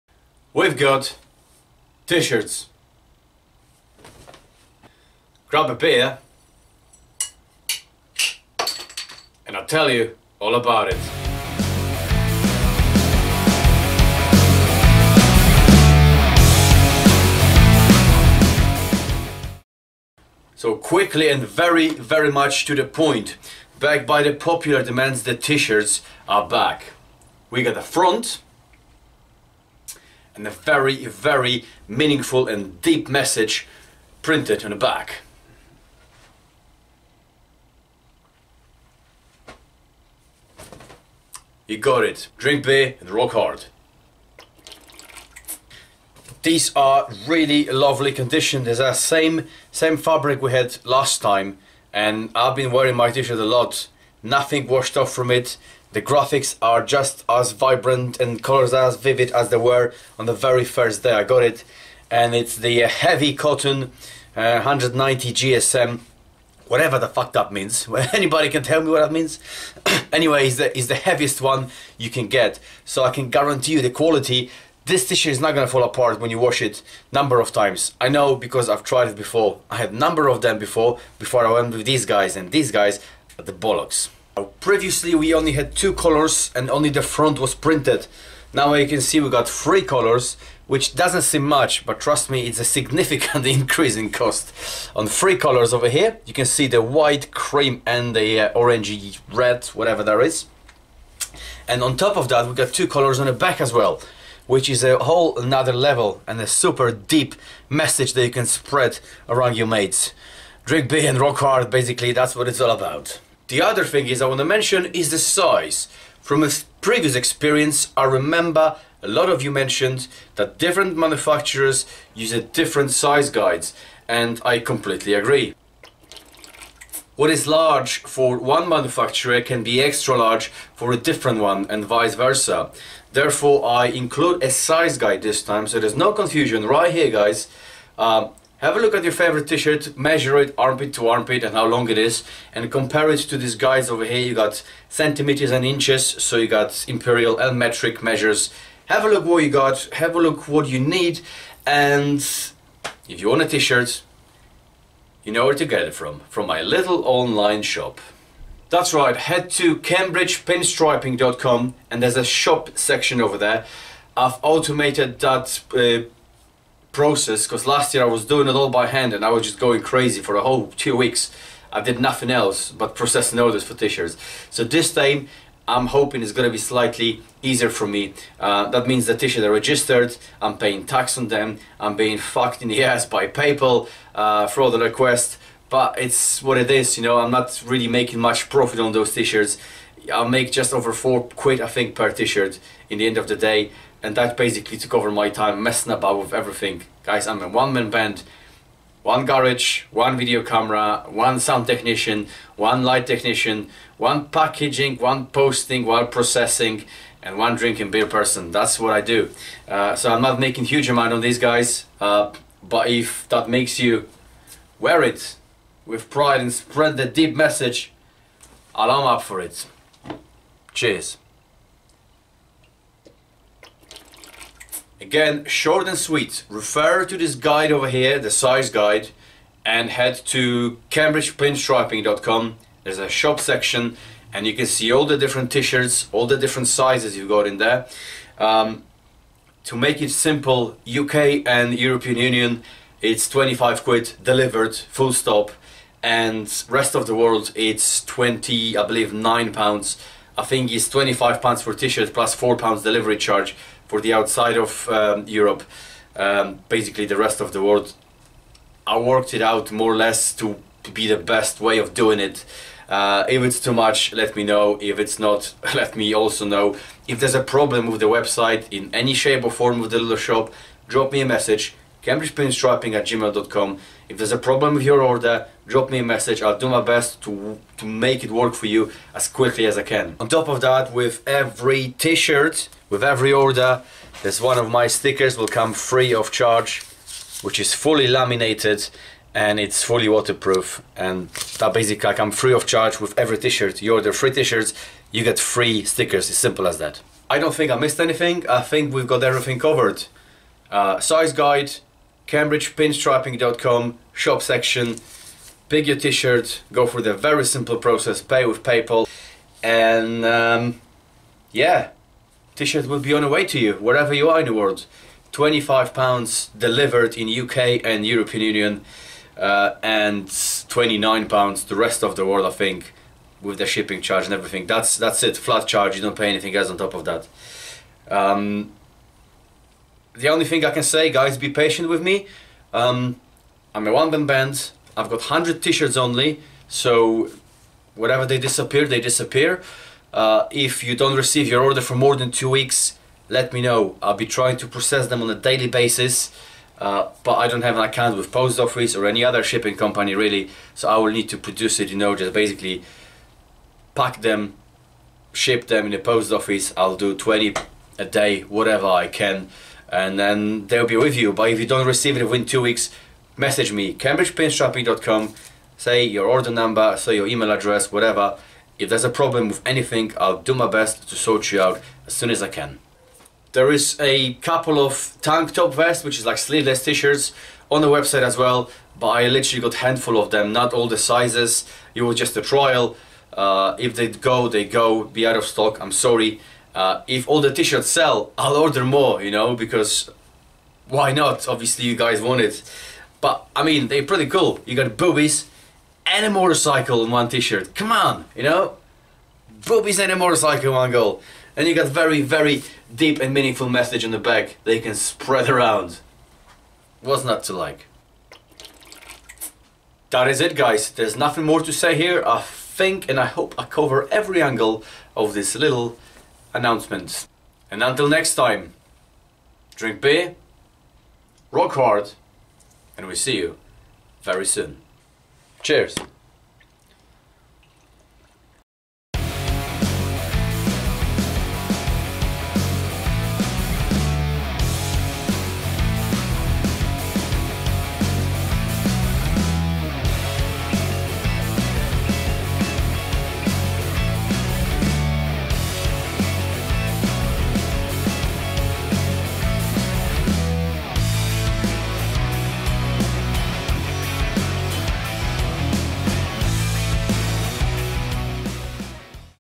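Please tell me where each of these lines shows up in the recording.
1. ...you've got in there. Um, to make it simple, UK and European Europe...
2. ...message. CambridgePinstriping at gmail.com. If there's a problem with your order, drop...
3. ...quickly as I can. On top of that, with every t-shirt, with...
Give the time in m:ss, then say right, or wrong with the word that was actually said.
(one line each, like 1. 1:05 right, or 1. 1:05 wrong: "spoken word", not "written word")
1. 3:57 wrong: "Union", not "Europe"
2. 4:31 right
3. 4:39 right.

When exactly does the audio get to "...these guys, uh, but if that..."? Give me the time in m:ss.
3:31.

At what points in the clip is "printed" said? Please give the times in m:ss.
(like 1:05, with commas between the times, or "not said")
0:34, 1:27.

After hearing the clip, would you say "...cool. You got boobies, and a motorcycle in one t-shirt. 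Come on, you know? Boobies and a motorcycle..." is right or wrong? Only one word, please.
right.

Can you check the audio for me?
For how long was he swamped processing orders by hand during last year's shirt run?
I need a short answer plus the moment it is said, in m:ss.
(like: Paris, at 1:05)
2 weeks, at 2:50.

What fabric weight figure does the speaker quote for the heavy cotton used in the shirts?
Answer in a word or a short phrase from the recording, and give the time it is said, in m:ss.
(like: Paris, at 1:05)
190 GSM, at 1:04.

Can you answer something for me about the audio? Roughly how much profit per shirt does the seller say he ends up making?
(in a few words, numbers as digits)
Just over £4.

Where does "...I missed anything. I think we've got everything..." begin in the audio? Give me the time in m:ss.
4:57.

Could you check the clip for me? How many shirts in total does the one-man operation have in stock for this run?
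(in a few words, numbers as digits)
100.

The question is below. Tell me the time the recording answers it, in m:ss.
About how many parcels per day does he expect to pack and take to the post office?
5:57.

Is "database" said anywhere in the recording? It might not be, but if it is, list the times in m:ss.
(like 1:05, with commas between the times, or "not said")
not said.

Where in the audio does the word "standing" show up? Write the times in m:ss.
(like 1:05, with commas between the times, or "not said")
not said.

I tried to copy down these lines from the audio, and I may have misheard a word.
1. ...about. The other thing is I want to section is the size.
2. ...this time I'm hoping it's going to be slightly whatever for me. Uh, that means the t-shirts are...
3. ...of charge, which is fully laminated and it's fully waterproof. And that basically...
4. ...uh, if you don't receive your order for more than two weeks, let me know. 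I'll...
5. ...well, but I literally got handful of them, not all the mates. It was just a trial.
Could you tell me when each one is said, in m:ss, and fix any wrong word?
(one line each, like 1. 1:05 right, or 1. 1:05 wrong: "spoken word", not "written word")
1. 1:52 wrong: "mention", not "section"
2. 2:54 wrong: "easier", not "whatever"
3. 4:46 right
4. 5:40 right
5. 6:18 wrong: "sizes", not "mates".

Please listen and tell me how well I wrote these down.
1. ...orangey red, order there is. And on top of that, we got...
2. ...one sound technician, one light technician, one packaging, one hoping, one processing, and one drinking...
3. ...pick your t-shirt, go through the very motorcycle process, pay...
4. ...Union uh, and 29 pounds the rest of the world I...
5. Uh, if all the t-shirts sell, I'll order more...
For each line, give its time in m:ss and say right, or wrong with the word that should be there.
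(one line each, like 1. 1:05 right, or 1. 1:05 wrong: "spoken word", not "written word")
1. 1:38 wrong: "whatever", not "order"
2. 3:21 wrong: "posting", not "hoping"
3. 5:05 wrong: "simple", not "motorcycle"
4. 5:18 right
5. 6:26 right.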